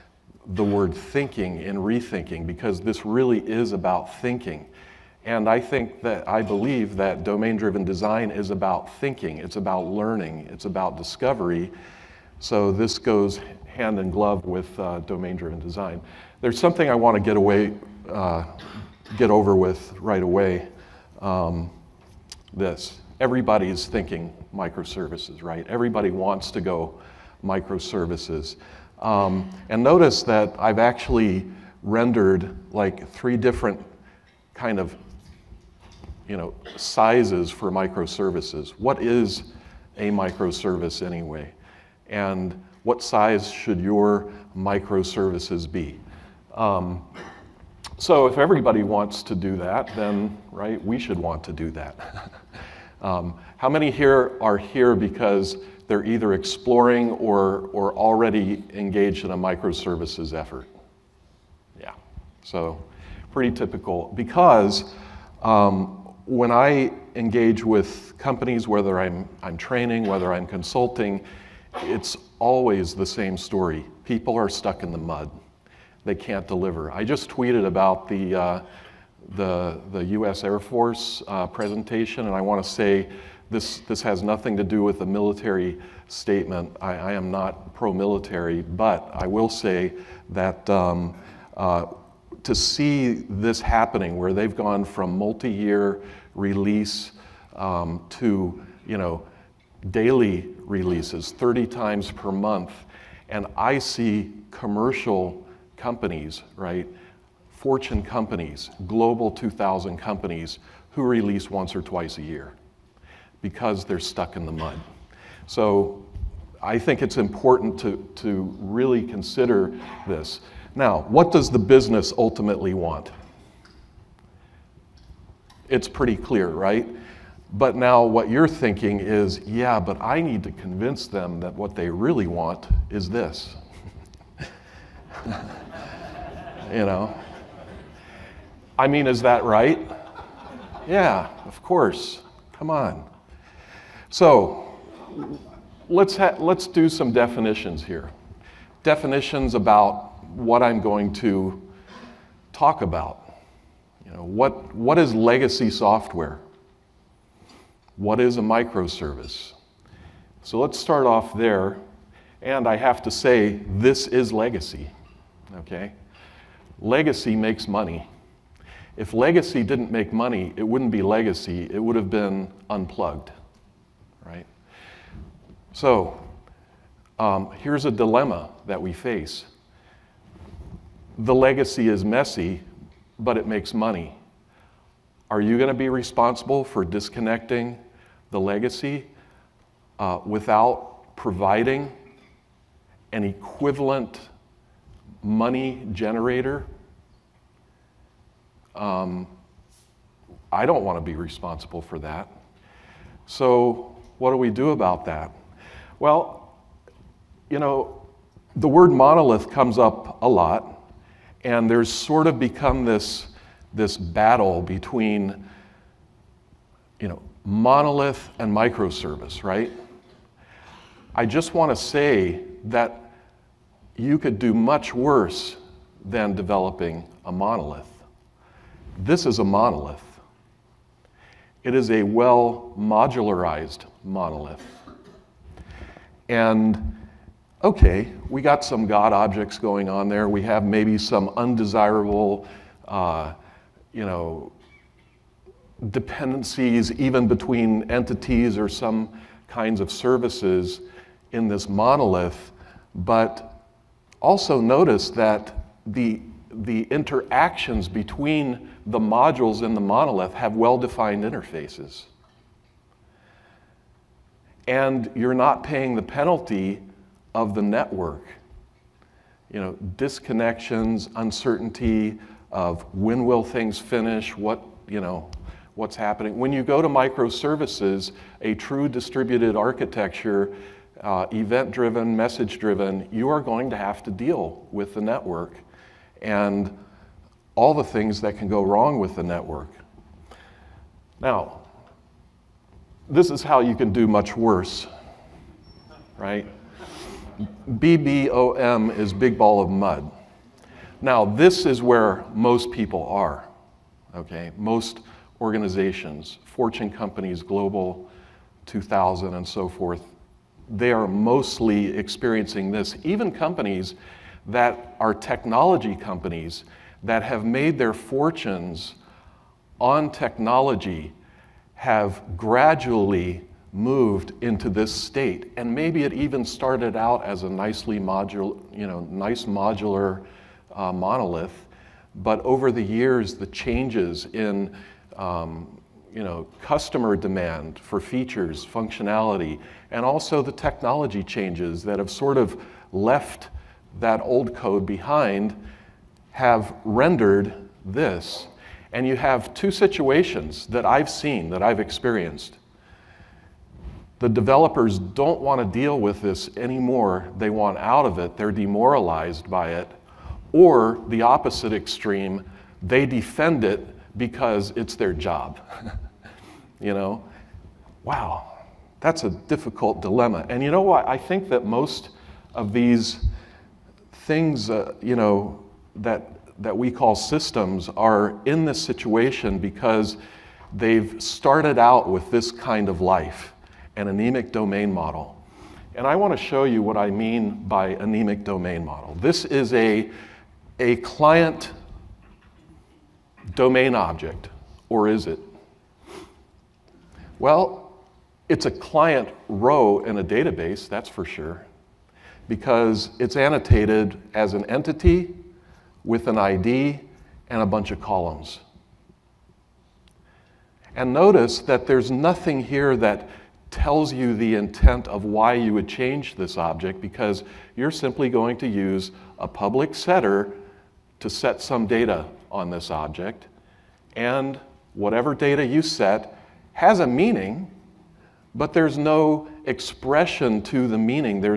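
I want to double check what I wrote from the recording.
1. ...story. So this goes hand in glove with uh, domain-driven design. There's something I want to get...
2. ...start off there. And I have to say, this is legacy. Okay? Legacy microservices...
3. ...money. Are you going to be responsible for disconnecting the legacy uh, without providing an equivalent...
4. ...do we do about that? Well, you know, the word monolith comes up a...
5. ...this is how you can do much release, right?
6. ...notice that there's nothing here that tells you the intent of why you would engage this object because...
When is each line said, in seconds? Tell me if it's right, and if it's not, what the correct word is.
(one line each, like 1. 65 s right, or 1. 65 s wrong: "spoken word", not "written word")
1. 10 s wrong: "discovery", not "story"
2. 160 s wrong: "makes", not "microservices"
3. 183 s right
4. 204 s right
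5. 293 s wrong: "worse", not "release"
6. 411 s wrong: "change", not "engage".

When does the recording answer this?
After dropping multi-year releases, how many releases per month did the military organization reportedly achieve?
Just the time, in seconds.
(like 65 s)
101 s.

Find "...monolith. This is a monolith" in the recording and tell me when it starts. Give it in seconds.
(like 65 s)
227 s.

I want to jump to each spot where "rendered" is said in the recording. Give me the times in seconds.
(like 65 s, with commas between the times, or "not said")
31 s, 346 s.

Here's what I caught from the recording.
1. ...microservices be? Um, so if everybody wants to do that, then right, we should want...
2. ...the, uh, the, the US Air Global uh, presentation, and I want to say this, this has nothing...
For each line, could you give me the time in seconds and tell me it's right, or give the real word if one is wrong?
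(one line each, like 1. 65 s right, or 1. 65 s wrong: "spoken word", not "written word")
1. 44 s right
2. 78 s wrong: "Force", not "Global".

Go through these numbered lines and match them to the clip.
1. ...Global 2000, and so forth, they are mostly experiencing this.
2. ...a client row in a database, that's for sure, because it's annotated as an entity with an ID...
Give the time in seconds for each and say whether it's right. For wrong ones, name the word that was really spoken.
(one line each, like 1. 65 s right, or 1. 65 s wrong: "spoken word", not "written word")
1. 307 s right
2. 398 s right.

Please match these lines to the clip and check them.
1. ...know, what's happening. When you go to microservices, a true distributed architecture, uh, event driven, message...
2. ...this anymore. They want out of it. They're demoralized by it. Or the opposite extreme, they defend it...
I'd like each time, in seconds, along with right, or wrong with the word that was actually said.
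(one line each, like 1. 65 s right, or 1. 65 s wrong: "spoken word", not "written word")
1. 274 s right
2. 356 s right.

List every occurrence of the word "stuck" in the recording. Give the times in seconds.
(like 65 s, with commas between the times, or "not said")
74 s, 113 s.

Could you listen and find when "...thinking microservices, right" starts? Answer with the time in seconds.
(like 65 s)
23 s.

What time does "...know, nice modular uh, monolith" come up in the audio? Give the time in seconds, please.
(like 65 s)
328 s.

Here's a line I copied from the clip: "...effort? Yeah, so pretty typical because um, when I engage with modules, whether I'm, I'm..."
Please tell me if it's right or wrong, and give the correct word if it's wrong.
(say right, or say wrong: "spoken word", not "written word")
wrong: "companies", not "modules".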